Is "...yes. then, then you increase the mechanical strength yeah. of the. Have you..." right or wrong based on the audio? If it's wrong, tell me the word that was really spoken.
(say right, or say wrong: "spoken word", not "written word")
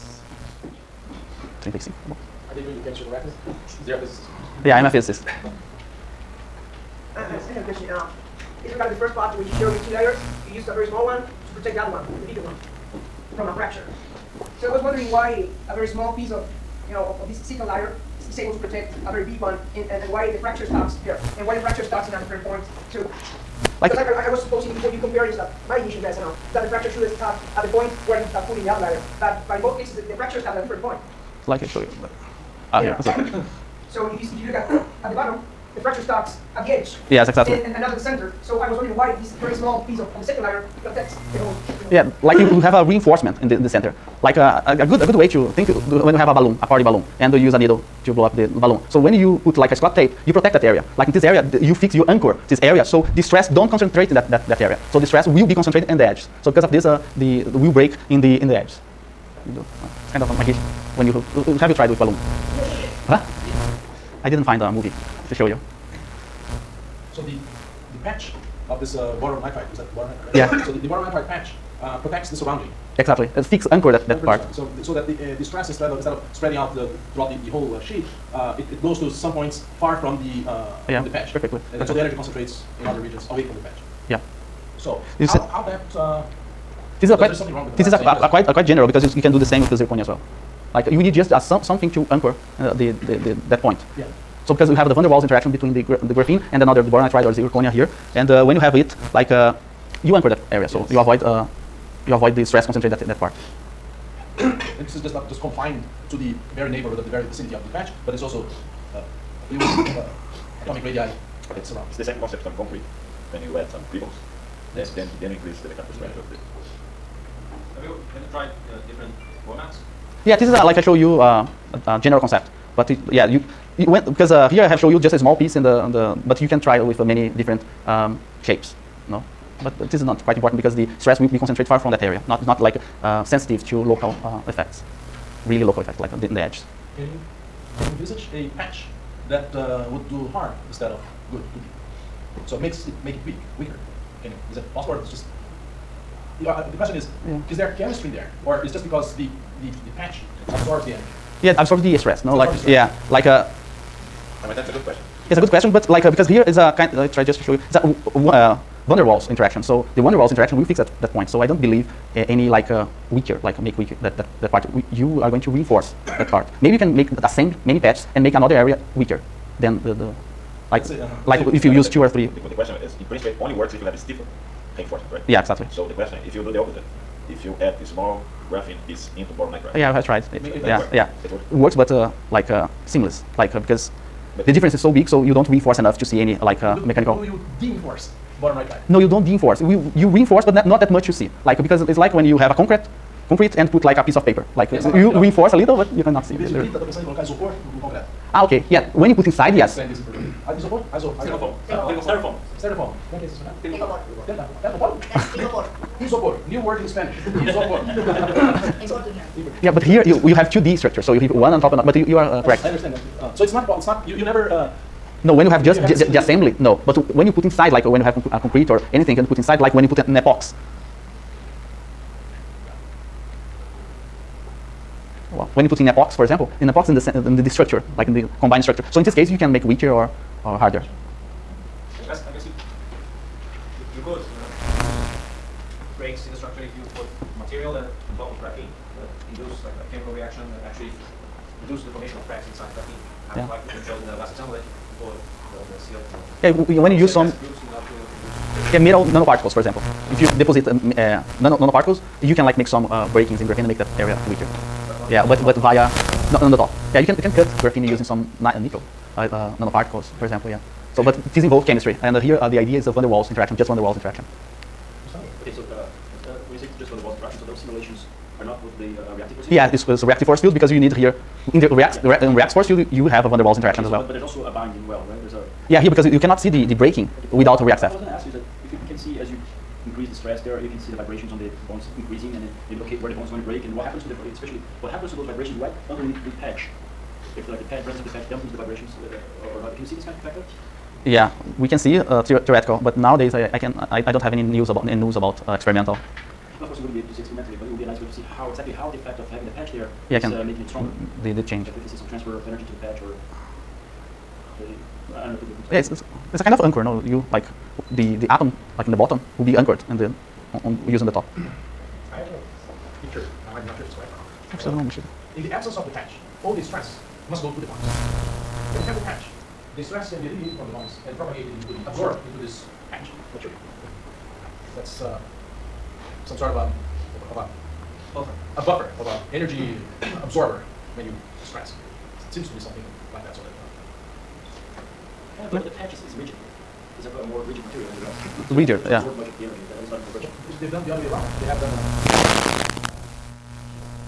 right.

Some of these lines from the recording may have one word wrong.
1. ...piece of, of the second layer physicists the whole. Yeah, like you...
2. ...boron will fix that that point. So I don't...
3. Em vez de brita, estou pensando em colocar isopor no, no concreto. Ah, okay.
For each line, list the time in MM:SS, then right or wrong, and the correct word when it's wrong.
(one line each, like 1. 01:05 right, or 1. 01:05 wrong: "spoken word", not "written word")
1. 00:39 wrong: "protects", not "physicists"
2. 02:40 wrong: "interaction", not "boron"
3. 03:16 right.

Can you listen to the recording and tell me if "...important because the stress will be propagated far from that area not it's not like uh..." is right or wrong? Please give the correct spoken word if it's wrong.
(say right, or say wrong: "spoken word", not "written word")
wrong: "concentrated", not "propagated".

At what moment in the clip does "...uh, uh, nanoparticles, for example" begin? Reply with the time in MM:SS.
04:19.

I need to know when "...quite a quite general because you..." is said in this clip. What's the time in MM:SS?
01:28.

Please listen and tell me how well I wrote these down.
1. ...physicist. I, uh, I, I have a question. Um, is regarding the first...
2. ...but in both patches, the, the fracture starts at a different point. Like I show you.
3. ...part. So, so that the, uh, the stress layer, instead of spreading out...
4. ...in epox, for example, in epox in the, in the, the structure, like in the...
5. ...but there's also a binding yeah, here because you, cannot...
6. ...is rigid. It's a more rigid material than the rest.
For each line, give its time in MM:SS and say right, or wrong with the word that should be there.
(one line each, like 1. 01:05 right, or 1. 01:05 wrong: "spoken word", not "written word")
1. 00:04 right
2. 00:29 wrong: "cases", not "patches"
3. 01:14 wrong: "rather", not "layer"
4. 03:45 right
5. 04:34 right
6. 05:36 right.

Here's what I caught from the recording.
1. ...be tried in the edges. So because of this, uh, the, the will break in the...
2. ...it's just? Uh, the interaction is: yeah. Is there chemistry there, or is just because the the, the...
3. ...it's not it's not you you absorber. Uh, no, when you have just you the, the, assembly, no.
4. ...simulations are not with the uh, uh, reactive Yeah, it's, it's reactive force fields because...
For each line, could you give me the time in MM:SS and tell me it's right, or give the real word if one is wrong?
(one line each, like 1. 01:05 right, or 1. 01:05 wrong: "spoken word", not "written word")
1. 00:55 wrong: "concentrated", not "tried"
2. 02:25 wrong: "question", not "interaction"
3. 03:33 wrong: "never", not "absorber"
4. 04:27 right.